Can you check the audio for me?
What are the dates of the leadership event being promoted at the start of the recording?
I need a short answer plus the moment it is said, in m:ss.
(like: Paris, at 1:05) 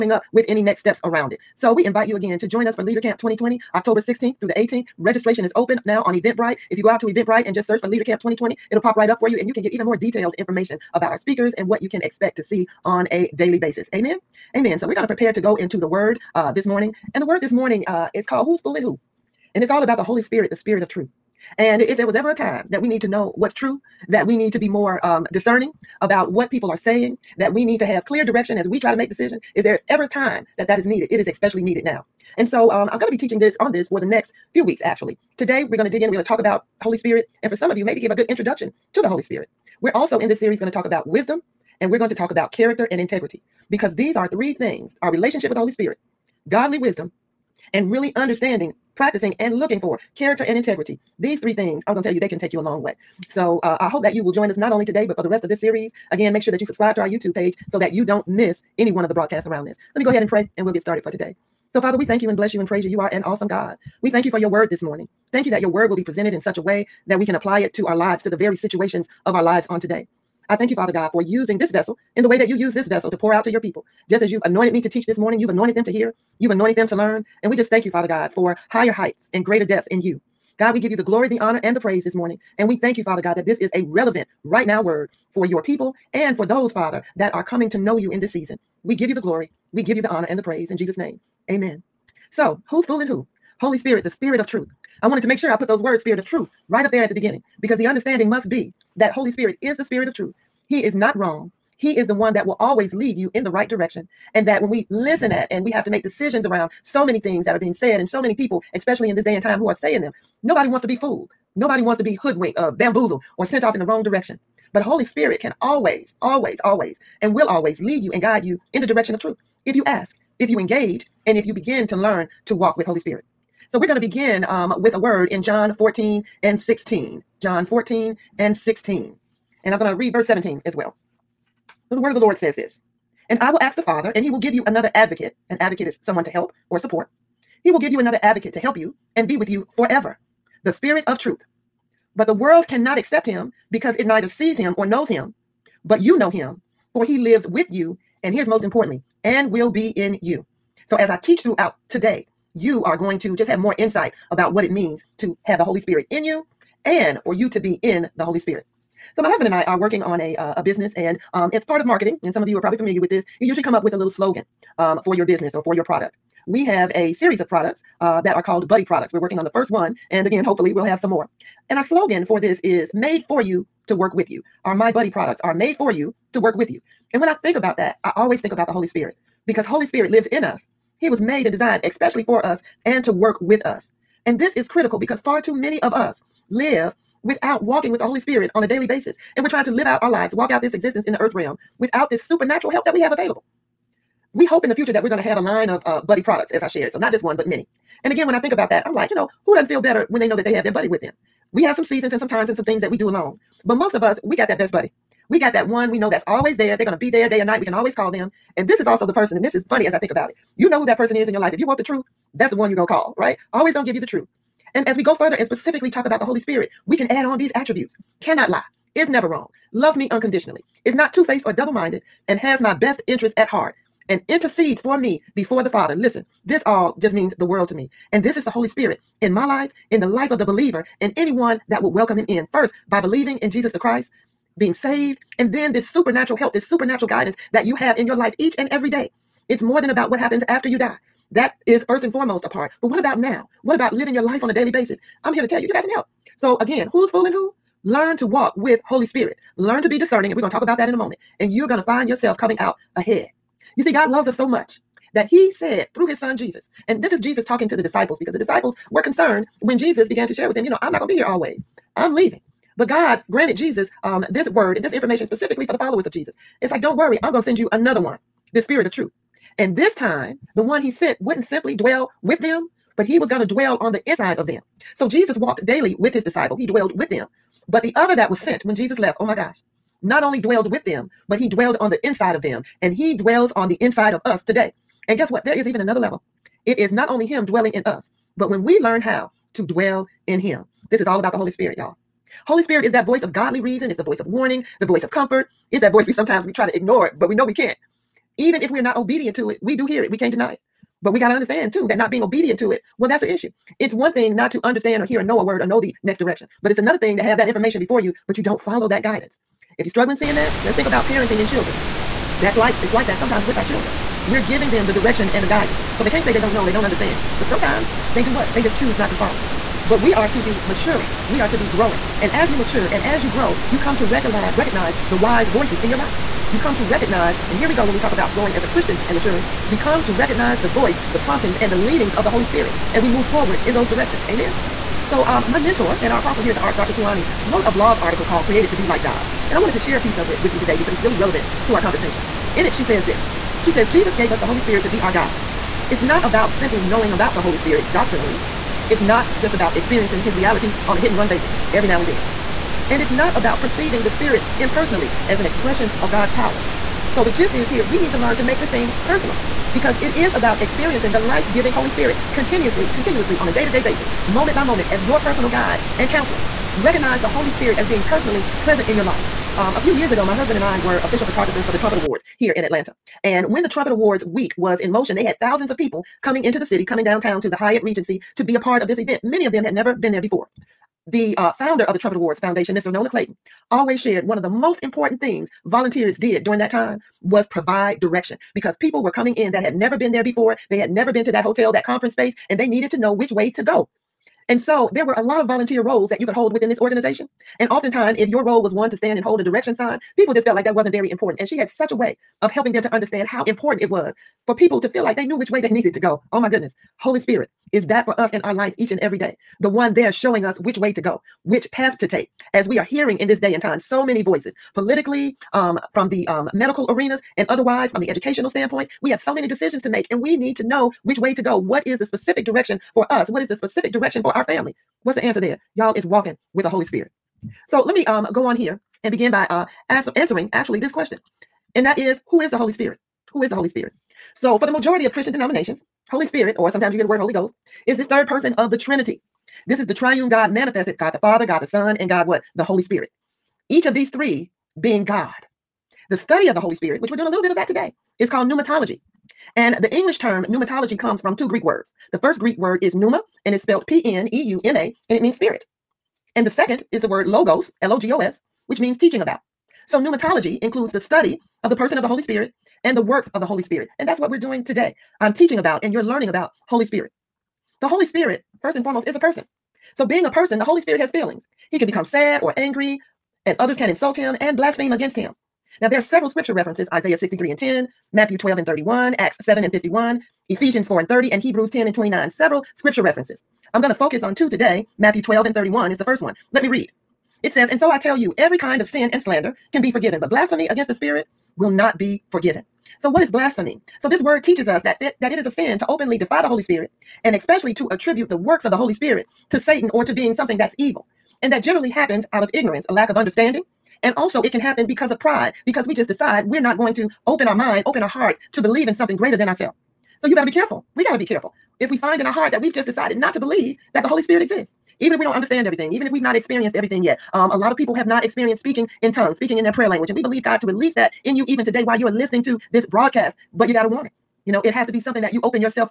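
October 16-18, at 0:03.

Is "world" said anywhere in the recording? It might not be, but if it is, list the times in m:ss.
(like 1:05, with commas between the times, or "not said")
2:22, 3:47.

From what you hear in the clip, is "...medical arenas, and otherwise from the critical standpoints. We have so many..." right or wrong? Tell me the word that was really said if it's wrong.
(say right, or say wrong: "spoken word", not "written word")
wrong: "educational", not "critical".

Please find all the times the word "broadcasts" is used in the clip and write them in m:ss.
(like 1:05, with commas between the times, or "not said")
0:59, 8:42.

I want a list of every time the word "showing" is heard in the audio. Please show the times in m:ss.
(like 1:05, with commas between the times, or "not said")
6:50.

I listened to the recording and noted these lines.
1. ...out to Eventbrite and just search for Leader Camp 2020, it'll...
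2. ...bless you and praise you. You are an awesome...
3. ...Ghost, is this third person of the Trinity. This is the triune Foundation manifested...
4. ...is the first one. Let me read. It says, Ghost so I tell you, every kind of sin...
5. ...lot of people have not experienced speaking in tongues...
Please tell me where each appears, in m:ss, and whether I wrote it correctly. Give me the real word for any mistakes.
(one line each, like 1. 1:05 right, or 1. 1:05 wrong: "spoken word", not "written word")
1. 0:06 right
2. 1:02 right
3. 7:17 wrong: "God", not "Foundation"
4. 8:05 wrong: "And", not "Ghost"
5. 8:37 right.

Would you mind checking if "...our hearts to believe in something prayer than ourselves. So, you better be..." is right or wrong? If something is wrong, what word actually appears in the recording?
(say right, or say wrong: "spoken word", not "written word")
wrong: "greater", not "prayer".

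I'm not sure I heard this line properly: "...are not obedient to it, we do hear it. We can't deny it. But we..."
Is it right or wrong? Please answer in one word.
right.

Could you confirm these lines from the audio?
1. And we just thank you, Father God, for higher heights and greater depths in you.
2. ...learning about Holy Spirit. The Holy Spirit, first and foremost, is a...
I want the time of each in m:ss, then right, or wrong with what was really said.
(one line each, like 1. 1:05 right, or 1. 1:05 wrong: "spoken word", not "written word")
1. 1:17 right
2. 7:46 right.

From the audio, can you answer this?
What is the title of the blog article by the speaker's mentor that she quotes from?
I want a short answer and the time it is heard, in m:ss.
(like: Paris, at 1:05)
Created to Be Like God, at 5:38.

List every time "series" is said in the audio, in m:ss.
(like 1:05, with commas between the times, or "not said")
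0:40, 0:55, 2:47.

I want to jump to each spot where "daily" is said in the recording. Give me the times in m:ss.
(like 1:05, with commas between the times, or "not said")
0:13, 3:08, 4:04, 4:35.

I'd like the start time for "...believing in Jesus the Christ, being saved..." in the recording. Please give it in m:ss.
3:52.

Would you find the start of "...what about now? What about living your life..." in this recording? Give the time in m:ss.
4:02.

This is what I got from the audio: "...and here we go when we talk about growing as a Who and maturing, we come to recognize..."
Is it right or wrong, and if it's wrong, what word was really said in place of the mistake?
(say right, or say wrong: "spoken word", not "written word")
wrong: "Christian", not "Who".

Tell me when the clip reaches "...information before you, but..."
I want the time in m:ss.
5:07.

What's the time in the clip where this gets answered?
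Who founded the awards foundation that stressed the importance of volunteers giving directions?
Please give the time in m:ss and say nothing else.
6:22.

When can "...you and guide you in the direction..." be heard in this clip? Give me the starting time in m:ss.
1:58.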